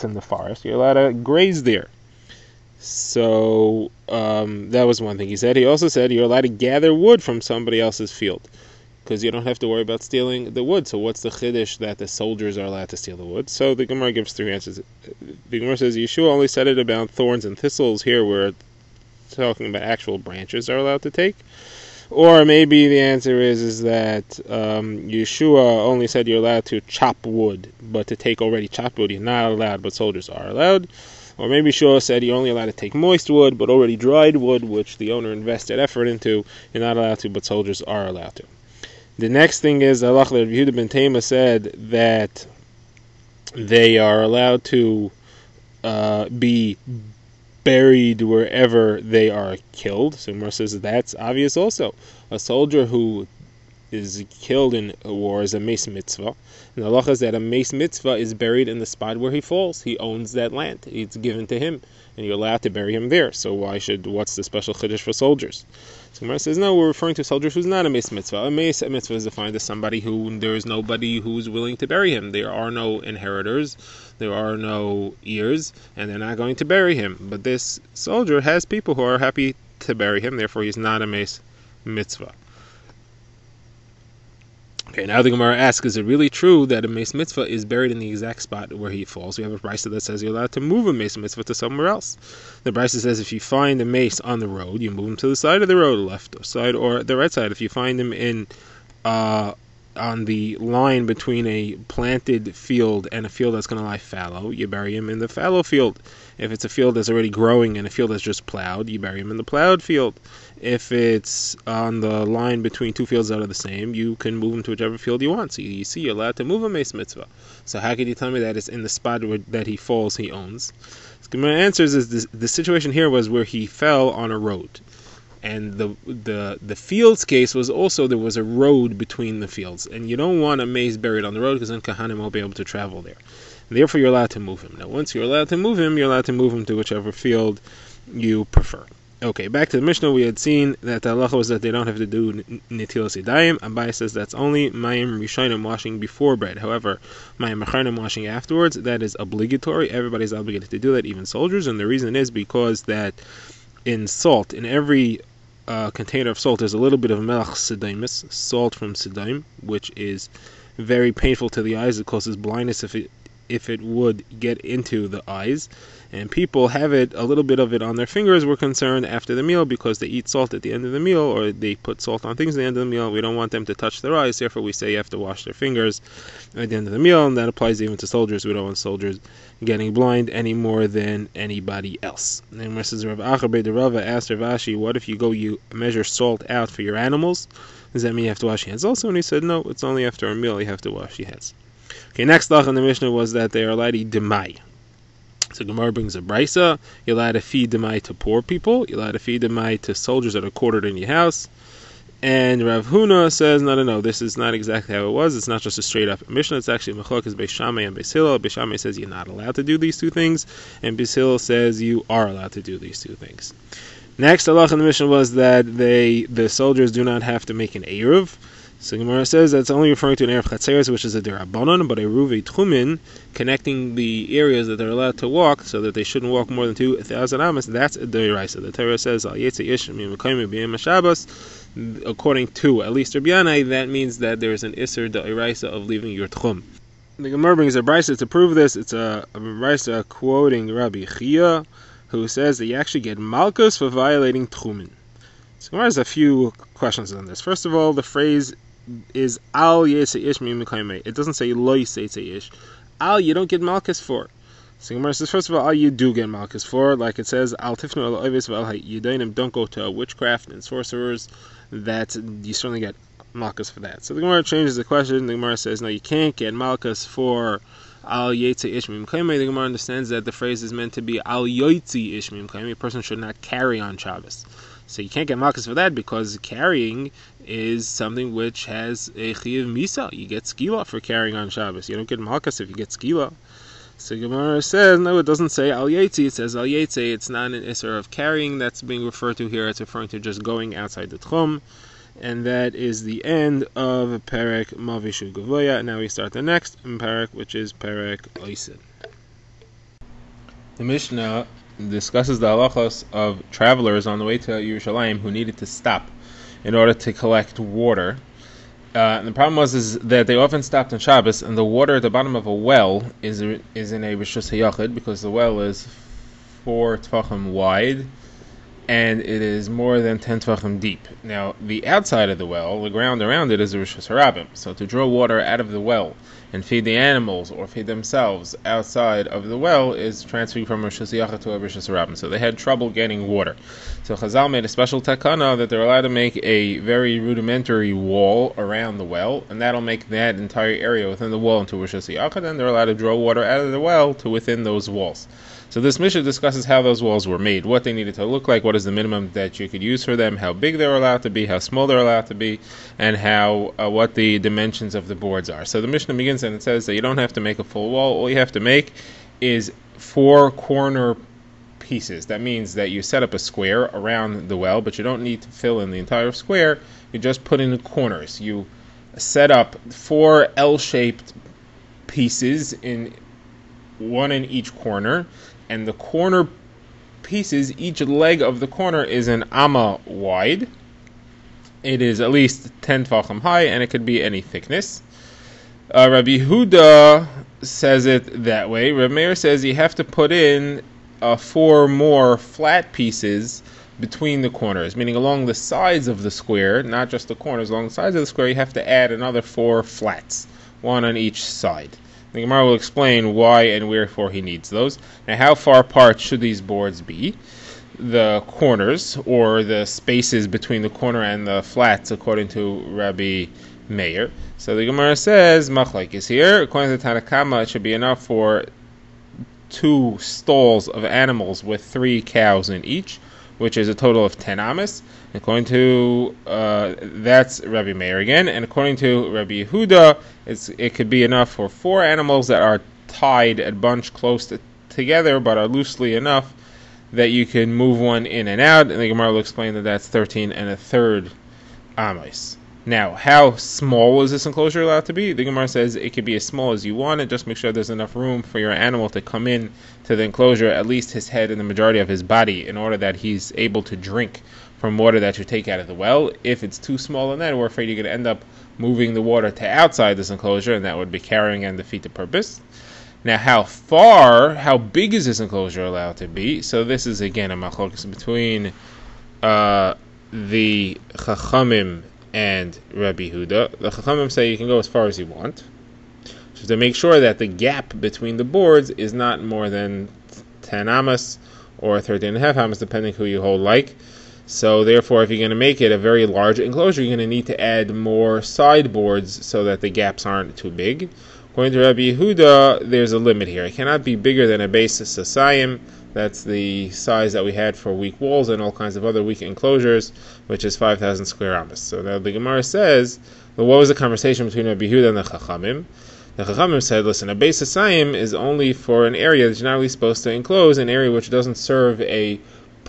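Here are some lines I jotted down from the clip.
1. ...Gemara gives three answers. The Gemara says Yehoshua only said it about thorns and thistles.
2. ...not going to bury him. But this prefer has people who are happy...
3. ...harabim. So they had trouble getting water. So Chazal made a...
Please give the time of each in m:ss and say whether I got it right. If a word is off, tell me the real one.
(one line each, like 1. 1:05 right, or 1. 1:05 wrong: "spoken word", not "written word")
1. 0:13 right
2. 1:16 wrong: "soldier", not "prefer"
3. 5:31 right.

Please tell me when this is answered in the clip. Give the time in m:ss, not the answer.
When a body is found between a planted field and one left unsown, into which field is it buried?
1:45.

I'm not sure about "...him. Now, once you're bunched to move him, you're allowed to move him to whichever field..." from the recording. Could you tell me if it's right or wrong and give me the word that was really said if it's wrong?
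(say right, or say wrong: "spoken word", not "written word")
wrong: "allowed", not "bunched".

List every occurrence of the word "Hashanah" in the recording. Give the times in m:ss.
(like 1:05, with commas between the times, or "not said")
5:31, 5:41.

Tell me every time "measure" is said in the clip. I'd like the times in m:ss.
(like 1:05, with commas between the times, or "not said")
3:05.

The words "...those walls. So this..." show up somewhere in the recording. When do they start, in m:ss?
5:44.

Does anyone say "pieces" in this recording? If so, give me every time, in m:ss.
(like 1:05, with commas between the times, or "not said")
6:01, 6:12, 6:17, 6:32.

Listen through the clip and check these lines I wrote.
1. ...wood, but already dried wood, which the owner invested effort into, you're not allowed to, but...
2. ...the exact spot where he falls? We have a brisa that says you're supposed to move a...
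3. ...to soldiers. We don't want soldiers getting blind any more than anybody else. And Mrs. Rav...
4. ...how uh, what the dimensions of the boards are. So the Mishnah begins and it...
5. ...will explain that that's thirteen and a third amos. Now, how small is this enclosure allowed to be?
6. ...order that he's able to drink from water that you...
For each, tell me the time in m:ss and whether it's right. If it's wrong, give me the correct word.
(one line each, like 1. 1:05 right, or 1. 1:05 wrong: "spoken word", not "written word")
1. 0:33 right
2. 1:27 wrong: "allowed", not "supposed"
3. 2:57 right
4. 5:53 right
5. 7:19 right
6. 7:32 right.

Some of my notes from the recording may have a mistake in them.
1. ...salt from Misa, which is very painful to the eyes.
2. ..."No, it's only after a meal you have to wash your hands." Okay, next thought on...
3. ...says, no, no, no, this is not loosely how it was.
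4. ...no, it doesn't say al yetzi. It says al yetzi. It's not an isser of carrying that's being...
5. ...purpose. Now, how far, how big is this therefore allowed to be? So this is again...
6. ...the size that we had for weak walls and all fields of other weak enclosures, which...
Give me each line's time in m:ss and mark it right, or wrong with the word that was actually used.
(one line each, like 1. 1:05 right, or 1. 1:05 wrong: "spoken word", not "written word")
1. 2:38 wrong: "Sedom", not "Misa"
2. 3:09 right
3. 3:23 wrong: "exactly", not "loosely"
4. 4:45 right
5. 7:42 wrong: "enclosure", not "therefore"
6. 8:16 wrong: "kinds", not "fields".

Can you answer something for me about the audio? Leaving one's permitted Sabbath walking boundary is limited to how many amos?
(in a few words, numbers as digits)
2,000.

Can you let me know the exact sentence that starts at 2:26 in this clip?
However, mayim acharim washing afterwards that is obligatory.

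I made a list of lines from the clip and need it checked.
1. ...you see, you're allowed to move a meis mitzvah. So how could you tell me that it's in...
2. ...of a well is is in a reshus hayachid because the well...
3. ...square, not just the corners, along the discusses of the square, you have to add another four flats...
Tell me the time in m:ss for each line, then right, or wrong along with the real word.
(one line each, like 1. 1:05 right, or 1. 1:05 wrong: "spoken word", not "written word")
1. 1:55 right
2. 5:12 wrong: "rishus", not "reshus"
3. 6:36 wrong: "sides", not "discusses".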